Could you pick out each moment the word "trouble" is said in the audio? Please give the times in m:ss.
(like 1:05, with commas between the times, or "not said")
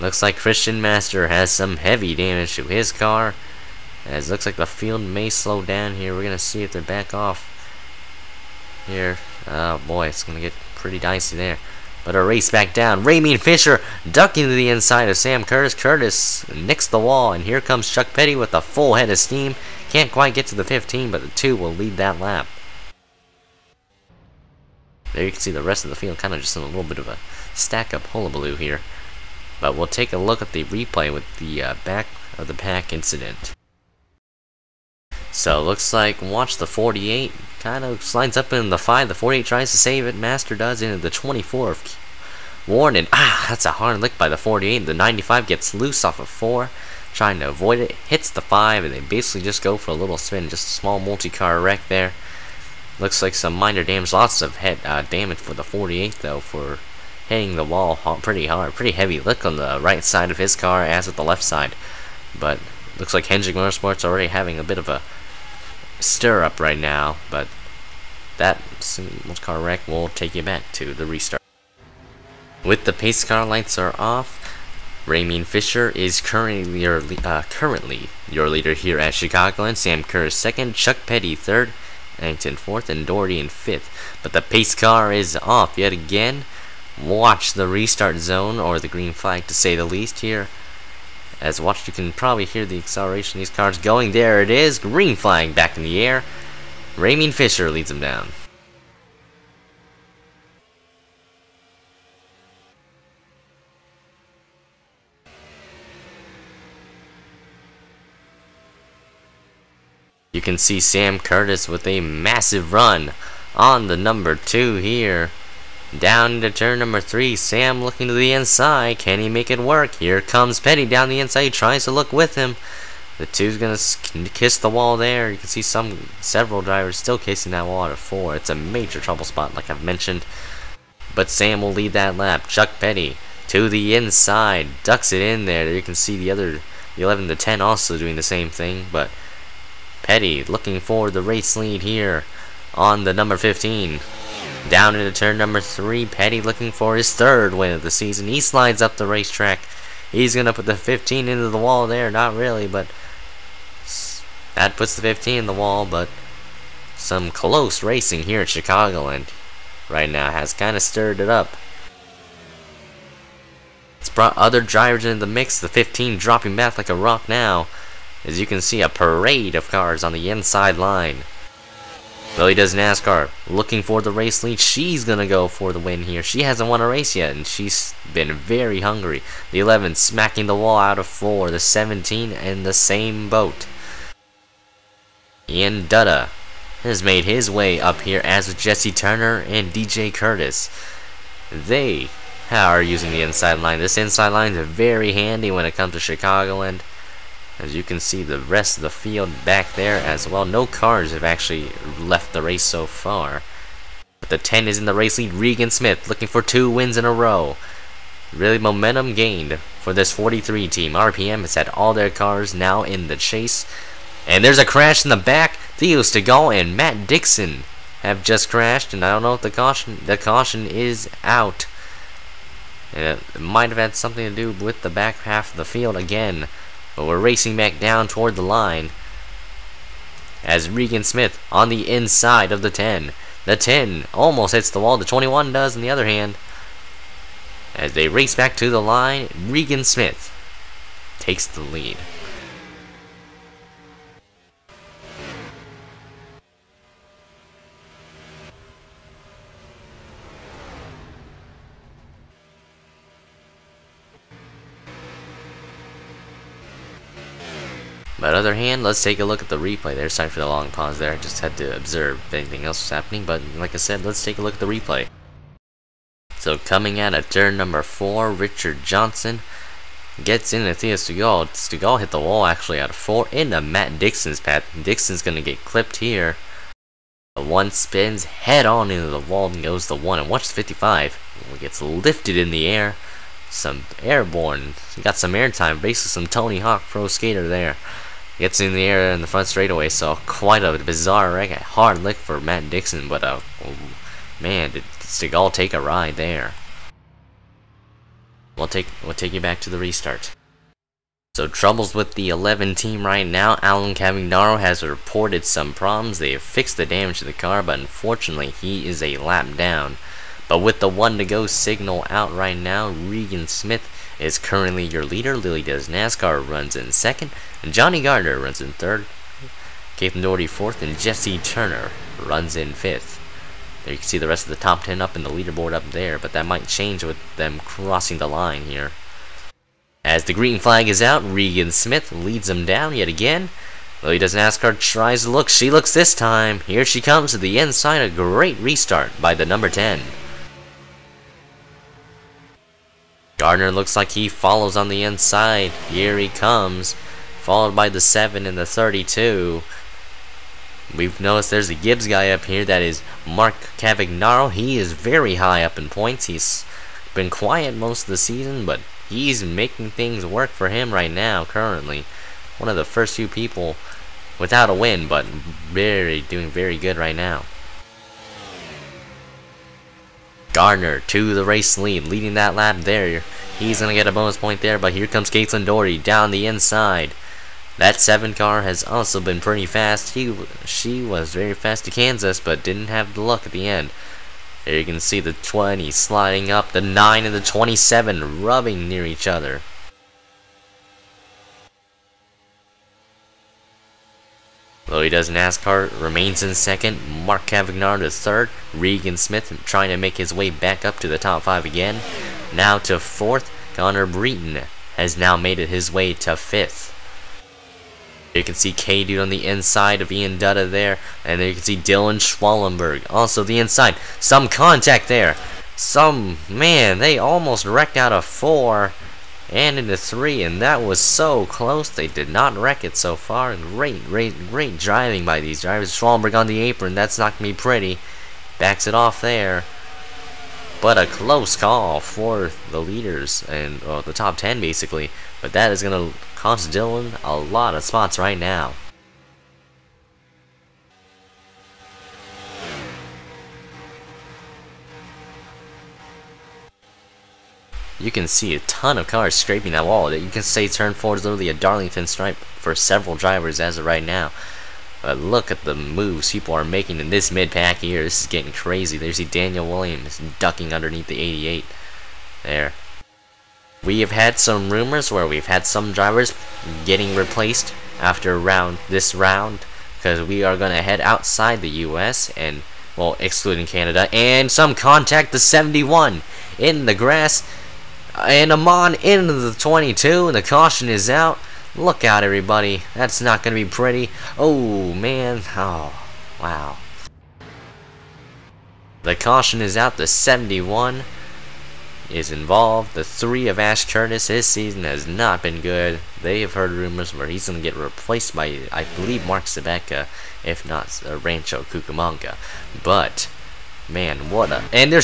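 2:09, 5:01.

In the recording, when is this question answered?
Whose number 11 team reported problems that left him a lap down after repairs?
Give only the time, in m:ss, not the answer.
5:03.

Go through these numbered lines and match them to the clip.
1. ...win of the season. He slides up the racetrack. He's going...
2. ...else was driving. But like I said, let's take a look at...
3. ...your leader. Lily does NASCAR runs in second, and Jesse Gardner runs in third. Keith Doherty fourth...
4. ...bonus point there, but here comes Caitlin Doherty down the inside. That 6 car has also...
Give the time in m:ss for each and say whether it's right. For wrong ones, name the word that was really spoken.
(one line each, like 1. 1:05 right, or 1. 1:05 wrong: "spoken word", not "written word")
1. 2:27 right
2. 4:22 wrong: "happening", not "driving"
3. 5:14 wrong: "Johnny", not "Jesse"
4. 6:14 wrong: "7", not "6".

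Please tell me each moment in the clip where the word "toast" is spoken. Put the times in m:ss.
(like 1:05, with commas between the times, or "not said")
not said.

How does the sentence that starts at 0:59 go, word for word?
Look on the right side of his car as at the left side.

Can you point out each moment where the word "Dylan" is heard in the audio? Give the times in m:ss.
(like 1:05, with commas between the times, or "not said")
6:51, 7:16.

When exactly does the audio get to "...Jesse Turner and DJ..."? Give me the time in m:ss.
3:08.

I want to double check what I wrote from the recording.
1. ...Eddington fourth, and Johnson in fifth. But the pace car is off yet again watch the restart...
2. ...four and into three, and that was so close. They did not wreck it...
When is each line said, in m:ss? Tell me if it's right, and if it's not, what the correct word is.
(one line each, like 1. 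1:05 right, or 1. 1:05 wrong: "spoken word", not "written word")
1. 1:22 wrong: "Doherty", not "Johnson"
2. 6:58 right.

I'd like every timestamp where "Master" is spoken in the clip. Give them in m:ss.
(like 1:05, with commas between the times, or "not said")
0:00, 0:40.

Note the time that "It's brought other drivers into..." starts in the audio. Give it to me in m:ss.
2:43.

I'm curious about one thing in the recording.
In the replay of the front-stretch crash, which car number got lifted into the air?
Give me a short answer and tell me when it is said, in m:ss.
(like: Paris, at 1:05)
55, at 4:40.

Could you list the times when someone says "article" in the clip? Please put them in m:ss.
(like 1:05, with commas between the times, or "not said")
not said.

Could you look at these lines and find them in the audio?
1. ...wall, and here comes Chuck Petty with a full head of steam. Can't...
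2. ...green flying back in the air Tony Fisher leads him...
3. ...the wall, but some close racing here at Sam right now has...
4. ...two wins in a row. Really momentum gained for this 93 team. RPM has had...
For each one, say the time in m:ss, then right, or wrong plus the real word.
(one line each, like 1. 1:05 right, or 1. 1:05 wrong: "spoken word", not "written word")
1. 0:16 right
2. 1:34 wrong: "Raymond", not "Tony"
3. 2:35 wrong: "Chicagoland", not "Sam"
4. 3:26 wrong: "43", not "93".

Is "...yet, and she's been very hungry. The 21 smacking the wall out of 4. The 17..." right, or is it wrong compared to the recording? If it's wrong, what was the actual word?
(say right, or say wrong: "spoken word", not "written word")
wrong: "11", not "21".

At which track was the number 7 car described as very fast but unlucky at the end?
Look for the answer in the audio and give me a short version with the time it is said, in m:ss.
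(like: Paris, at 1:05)
Kansas, at 6:21.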